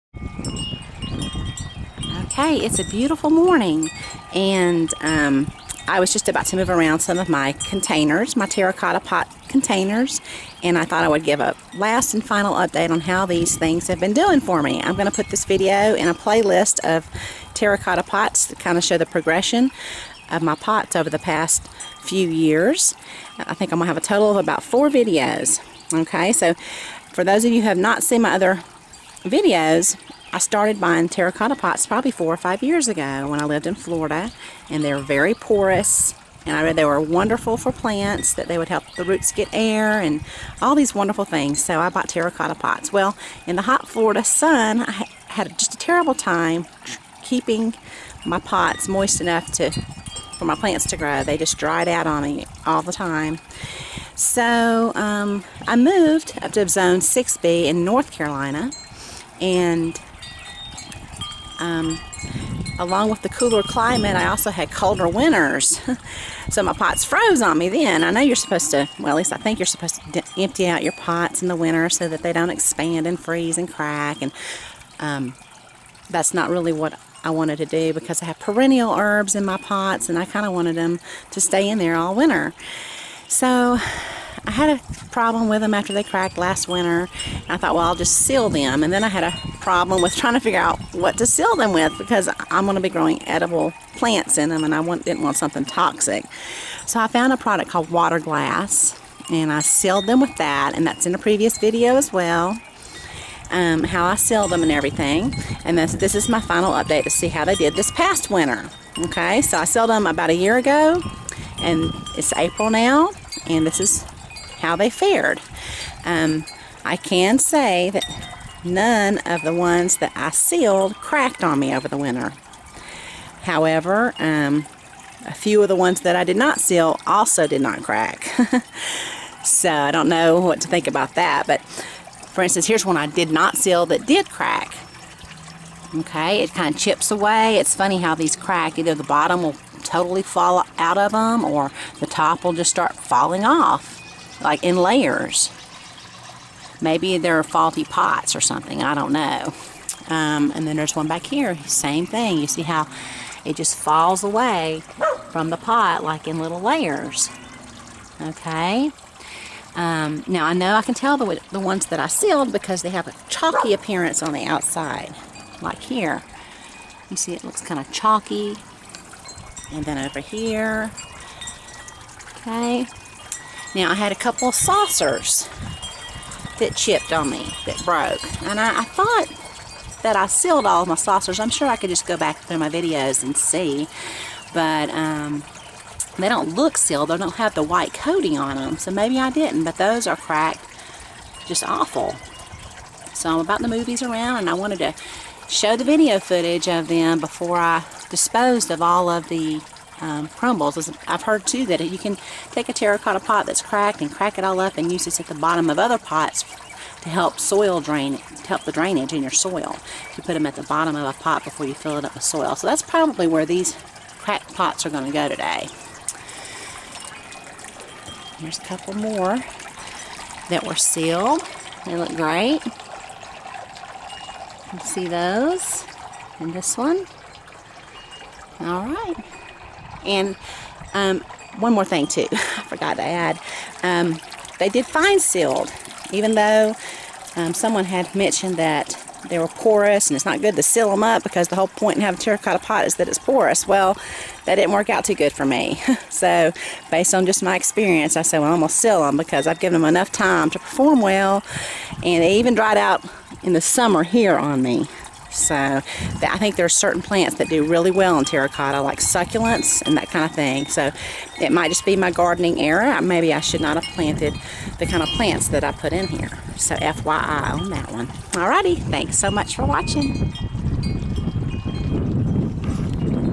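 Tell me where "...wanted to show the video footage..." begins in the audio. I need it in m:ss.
3:14.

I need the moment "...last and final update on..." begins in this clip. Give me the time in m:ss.
0:11.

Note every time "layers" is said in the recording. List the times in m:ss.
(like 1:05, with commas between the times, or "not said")
2:24, 2:36.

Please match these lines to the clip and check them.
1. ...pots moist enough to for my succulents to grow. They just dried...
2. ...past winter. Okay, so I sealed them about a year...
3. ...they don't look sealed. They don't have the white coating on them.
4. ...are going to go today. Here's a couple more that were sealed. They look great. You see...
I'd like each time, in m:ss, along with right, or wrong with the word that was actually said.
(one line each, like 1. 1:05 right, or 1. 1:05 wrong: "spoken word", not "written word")
1. 0:48 wrong: "plants", not "succulents"
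2. 1:47 right
3. 3:06 right
4. 3:34 right.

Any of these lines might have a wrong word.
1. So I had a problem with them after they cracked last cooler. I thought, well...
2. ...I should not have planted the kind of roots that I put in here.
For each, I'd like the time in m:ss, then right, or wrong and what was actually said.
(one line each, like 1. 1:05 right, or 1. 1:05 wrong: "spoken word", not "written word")
1. 1:23 wrong: "winter", not "cooler"
2. 4:23 wrong: "plants", not "roots".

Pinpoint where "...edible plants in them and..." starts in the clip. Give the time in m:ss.
1:33.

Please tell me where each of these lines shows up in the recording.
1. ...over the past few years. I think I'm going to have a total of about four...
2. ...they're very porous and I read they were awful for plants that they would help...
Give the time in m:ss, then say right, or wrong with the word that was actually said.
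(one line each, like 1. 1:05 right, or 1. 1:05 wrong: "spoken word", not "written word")
1. 0:20 right
2. 0:34 wrong: "wonderful", not "awful".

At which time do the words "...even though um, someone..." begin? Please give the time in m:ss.
3:56.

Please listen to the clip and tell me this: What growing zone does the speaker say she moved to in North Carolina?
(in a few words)
6B.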